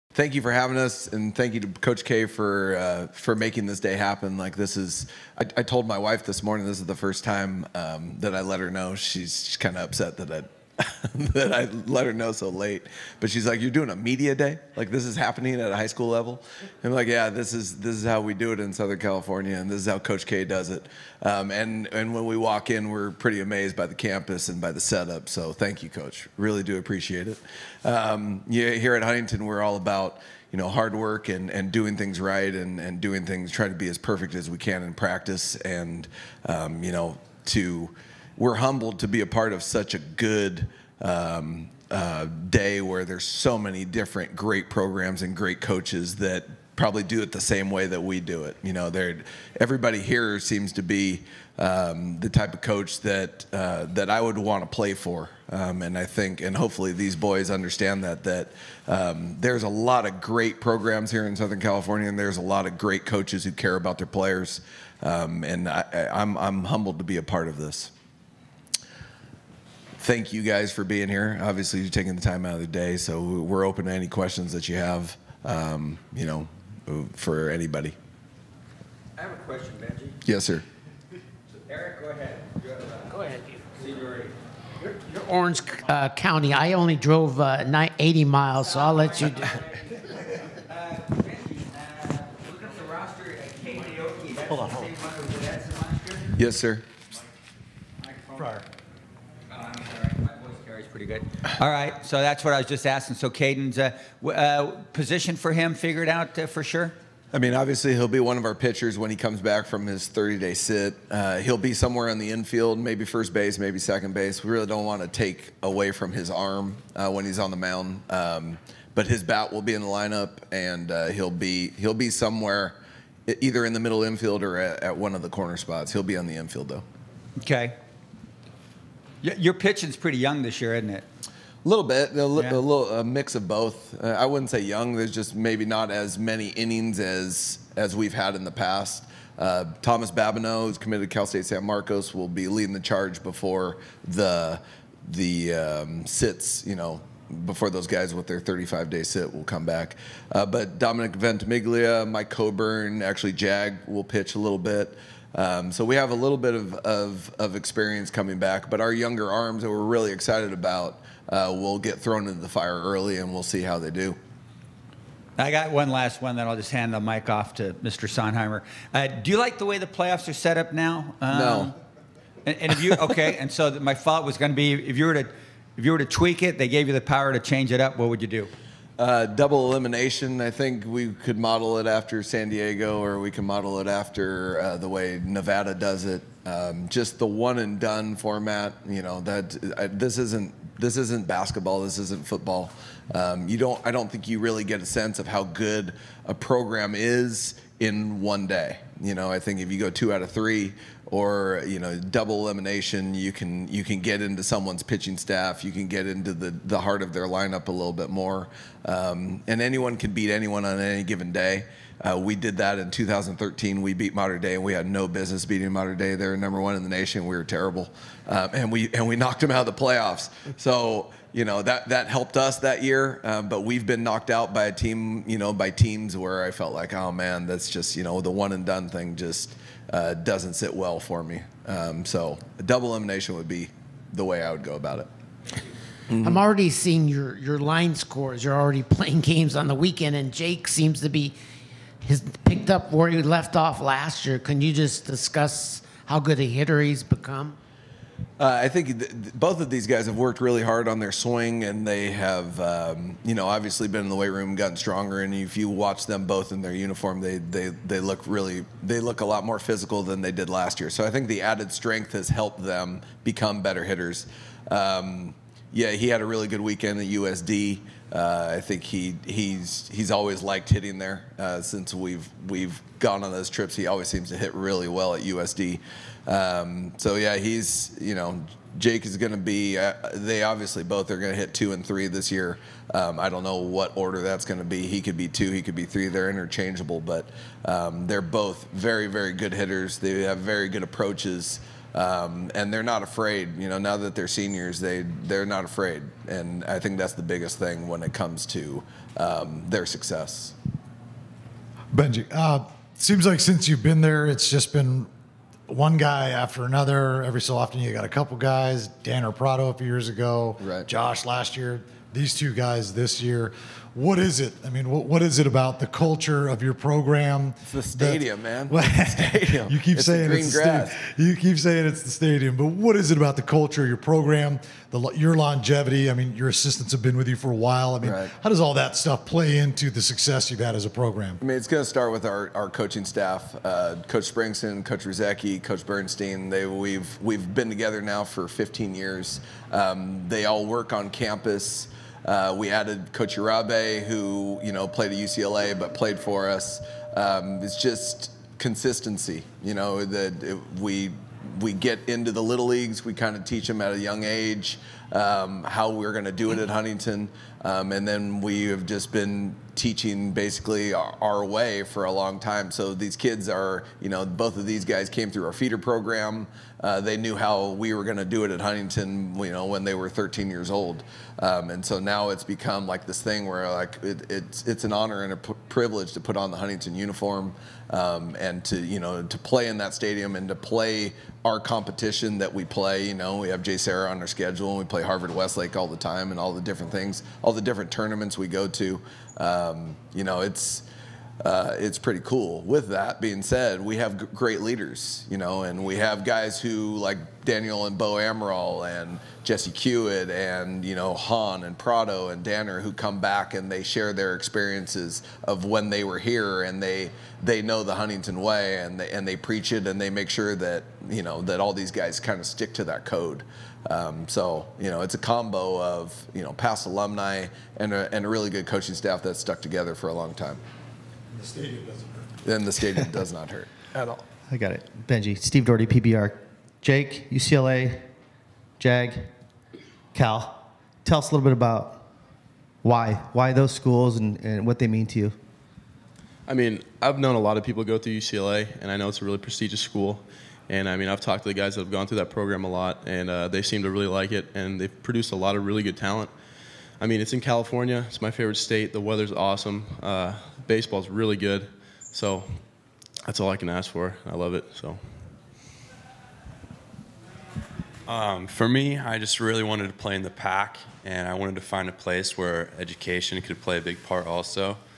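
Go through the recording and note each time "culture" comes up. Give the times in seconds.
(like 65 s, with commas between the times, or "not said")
315 s, 323 s.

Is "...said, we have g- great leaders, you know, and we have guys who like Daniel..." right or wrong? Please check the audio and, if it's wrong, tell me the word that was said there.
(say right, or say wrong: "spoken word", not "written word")
right.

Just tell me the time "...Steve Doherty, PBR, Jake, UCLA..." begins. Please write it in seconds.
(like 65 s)
425 s.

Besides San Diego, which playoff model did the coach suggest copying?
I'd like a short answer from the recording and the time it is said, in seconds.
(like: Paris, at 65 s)
Nevada, at 185 s.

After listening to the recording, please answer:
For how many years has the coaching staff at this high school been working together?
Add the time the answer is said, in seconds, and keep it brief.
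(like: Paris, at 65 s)
15, at 338 s.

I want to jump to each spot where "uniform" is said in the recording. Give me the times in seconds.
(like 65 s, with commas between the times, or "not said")
256 s, 376 s.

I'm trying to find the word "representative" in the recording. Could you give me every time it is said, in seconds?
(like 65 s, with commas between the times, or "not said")
not said.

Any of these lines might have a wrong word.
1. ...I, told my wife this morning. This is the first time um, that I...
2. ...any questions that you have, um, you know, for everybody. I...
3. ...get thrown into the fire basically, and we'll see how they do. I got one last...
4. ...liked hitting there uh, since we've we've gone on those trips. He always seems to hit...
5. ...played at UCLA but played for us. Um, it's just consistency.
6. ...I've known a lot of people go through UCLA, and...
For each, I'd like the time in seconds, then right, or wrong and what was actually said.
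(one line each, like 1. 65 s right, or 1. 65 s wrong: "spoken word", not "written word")
1. 5 s right
2. 73 s wrong: "anybody", not "everybody"
3. 161 s wrong: "early", not "basically"
4. 270 s right
5. 344 s right
6. 436 s right.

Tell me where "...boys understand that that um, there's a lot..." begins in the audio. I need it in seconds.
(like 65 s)
57 s.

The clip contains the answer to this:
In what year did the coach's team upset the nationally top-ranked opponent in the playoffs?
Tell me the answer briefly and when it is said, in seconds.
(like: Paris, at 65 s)
2013, at 212 s.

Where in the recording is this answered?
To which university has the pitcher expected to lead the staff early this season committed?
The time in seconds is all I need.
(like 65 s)
141 s.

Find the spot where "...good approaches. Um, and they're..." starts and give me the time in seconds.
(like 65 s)
290 s.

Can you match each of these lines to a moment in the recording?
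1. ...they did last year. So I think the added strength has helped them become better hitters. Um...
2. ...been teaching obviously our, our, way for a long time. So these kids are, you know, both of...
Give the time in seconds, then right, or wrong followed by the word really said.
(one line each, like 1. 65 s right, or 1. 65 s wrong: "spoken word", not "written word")
1. 260 s right
2. 359 s wrong: "basically", not "obviously".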